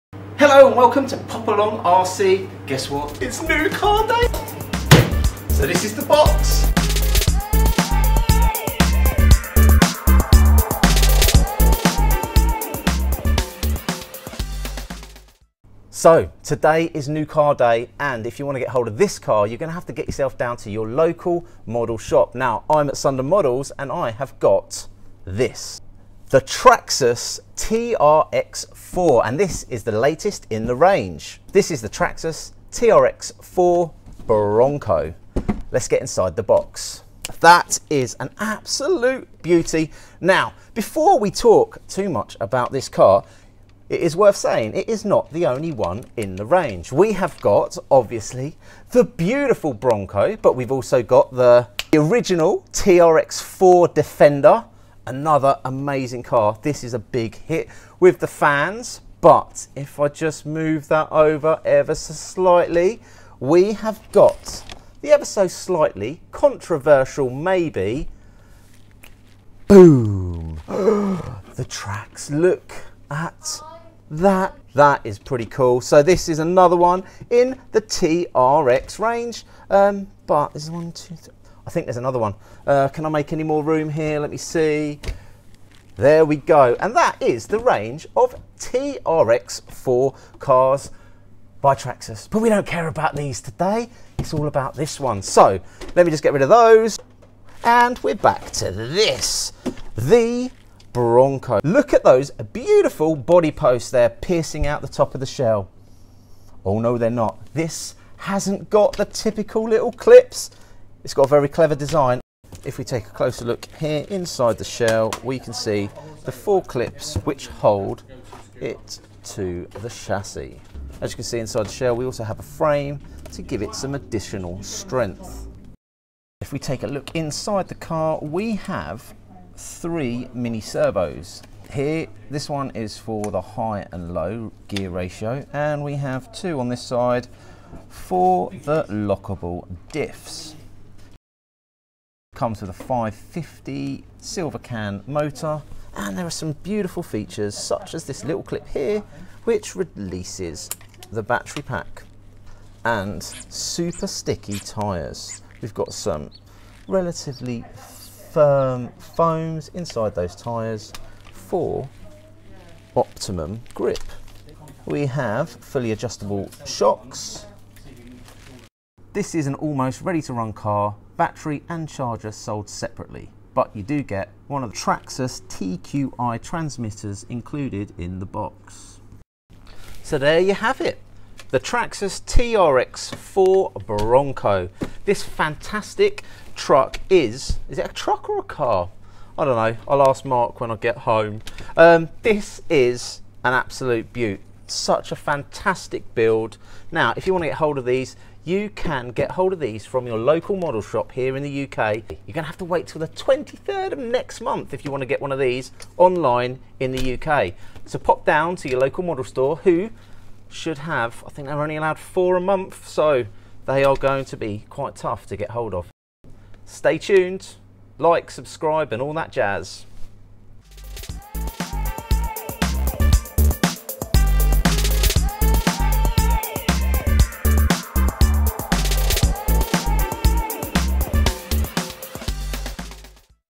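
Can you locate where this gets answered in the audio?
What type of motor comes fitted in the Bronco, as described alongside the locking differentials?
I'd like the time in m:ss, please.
2:22.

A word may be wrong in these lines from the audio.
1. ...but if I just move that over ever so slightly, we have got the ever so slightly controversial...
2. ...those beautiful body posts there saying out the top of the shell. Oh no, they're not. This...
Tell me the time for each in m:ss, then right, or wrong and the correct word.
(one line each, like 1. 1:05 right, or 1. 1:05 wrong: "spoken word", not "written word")
1. 0:59 right
2. 1:42 wrong: "piercing", not "saying".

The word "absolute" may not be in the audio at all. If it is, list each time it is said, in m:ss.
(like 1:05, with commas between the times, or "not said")
0:38, 3:13.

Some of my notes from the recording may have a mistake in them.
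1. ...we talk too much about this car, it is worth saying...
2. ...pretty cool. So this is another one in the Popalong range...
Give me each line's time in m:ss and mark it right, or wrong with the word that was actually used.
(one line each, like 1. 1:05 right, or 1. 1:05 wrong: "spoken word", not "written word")
1. 0:41 right
2. 1:15 wrong: "TRX", not "Popalong".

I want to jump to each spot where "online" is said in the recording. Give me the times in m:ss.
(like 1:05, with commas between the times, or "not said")
3:25.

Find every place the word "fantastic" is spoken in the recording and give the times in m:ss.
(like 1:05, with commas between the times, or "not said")
3:05, 3:15.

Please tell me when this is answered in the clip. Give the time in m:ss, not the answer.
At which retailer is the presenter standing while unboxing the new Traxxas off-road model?
0:22.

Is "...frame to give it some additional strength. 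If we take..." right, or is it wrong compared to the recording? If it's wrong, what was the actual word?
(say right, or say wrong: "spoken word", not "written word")
right.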